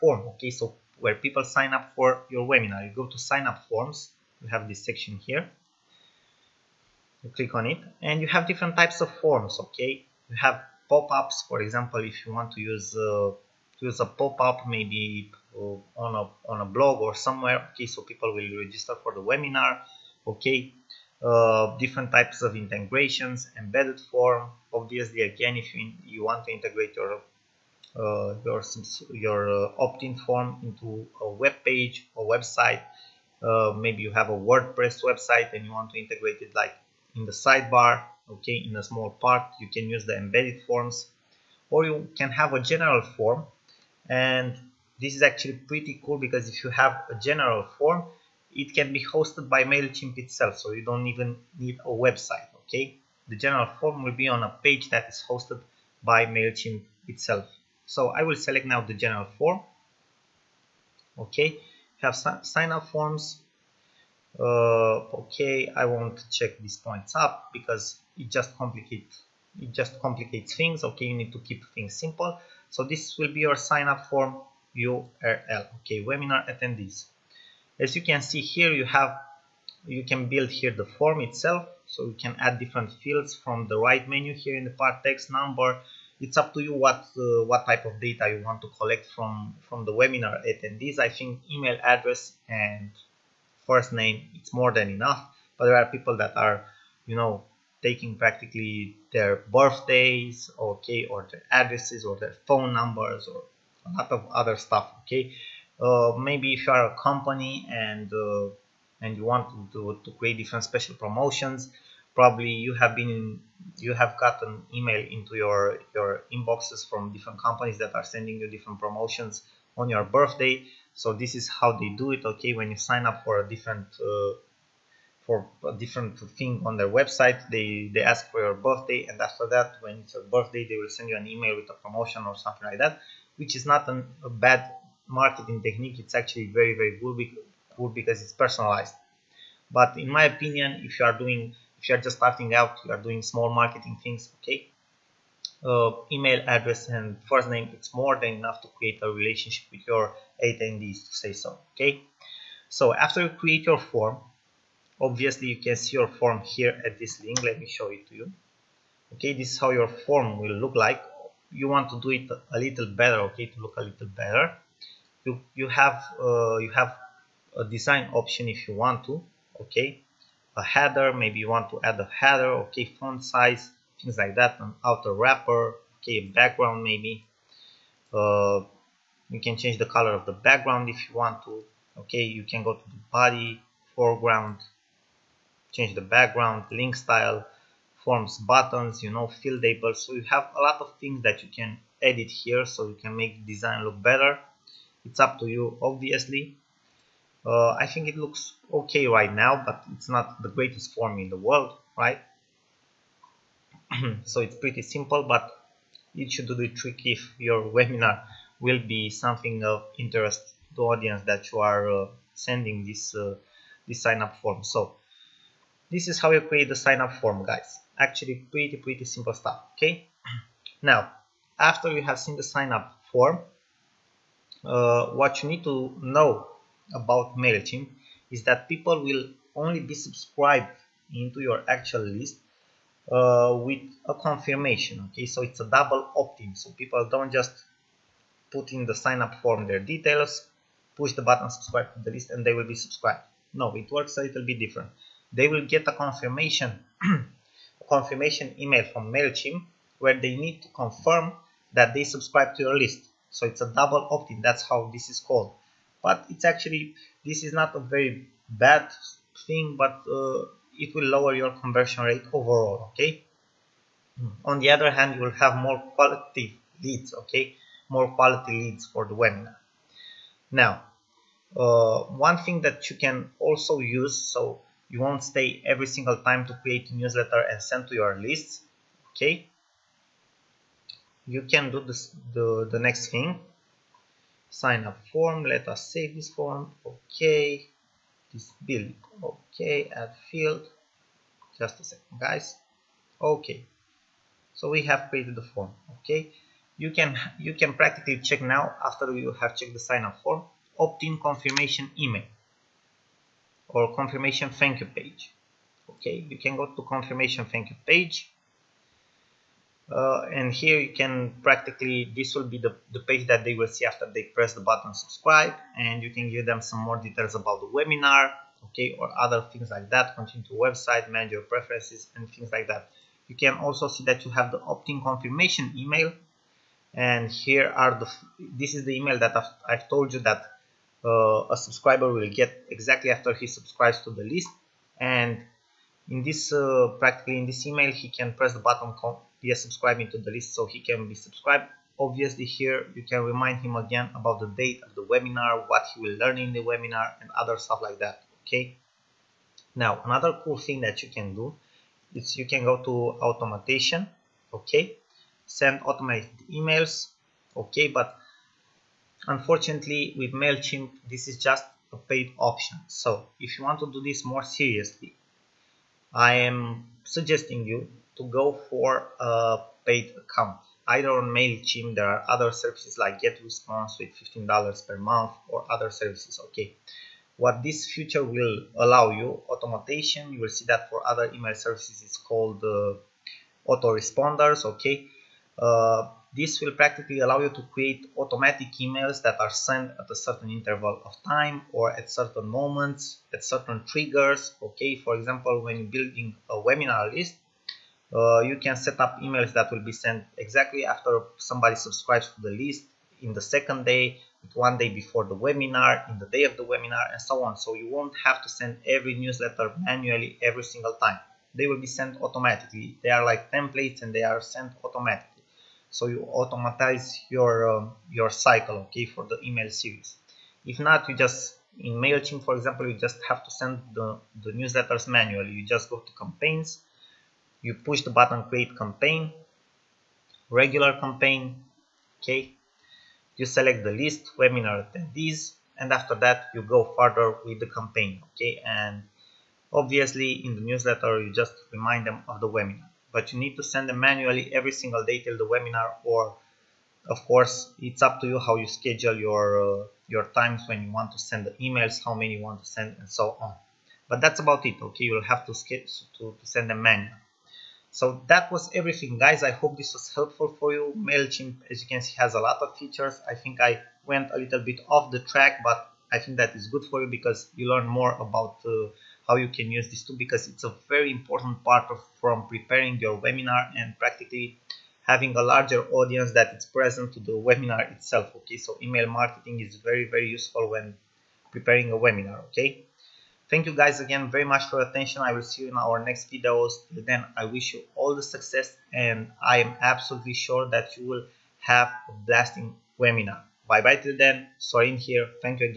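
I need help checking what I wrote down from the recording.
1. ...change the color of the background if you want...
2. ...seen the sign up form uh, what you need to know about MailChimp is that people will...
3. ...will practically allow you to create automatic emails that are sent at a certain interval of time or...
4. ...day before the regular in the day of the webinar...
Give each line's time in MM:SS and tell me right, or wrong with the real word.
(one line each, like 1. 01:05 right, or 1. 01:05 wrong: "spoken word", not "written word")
1. 02:59 right
2. 03:42 right
3. 06:26 right
4. 06:44 wrong: "webinar", not "regular".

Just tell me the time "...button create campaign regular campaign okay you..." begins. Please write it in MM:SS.
07:08.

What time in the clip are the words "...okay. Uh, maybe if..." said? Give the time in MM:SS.
01:45.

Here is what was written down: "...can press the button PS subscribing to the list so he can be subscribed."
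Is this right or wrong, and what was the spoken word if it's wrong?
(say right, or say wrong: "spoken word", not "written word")
right.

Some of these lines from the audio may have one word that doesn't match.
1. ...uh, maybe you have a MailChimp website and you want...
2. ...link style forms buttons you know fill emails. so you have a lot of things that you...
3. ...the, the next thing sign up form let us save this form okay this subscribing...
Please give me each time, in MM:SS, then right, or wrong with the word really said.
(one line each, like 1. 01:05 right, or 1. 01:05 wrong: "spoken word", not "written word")
1. 00:33 wrong: "WordPress", not "MailChimp"
2. 03:06 wrong: "labels", not "emails"
3. 04:42 wrong: "building", not "subscribing".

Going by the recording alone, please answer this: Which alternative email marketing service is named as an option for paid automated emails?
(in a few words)
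GetResponse.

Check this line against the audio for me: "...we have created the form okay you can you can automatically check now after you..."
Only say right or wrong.
wrong.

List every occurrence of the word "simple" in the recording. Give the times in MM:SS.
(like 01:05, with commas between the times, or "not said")
01:11, 03:24, 03:39.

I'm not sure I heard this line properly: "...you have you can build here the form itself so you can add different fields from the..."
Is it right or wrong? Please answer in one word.
right.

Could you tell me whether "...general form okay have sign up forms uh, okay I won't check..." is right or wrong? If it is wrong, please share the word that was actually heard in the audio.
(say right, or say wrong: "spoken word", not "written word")
right.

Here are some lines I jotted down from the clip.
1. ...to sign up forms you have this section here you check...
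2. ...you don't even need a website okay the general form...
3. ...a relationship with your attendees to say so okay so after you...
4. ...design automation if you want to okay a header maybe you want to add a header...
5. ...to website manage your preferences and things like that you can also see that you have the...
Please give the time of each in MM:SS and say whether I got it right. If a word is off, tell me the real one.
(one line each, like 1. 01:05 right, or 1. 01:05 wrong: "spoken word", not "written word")
1. 00:03 wrong: "click", not "check"
2. 00:50 right
3. 02:29 right
4. 02:47 wrong: "option", not "automation"
5. 05:20 right.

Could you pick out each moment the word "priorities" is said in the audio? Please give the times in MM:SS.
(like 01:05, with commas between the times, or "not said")
not said.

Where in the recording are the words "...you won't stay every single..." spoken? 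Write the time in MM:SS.
04:34.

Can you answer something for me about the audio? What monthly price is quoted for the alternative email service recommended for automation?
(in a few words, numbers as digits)
$15.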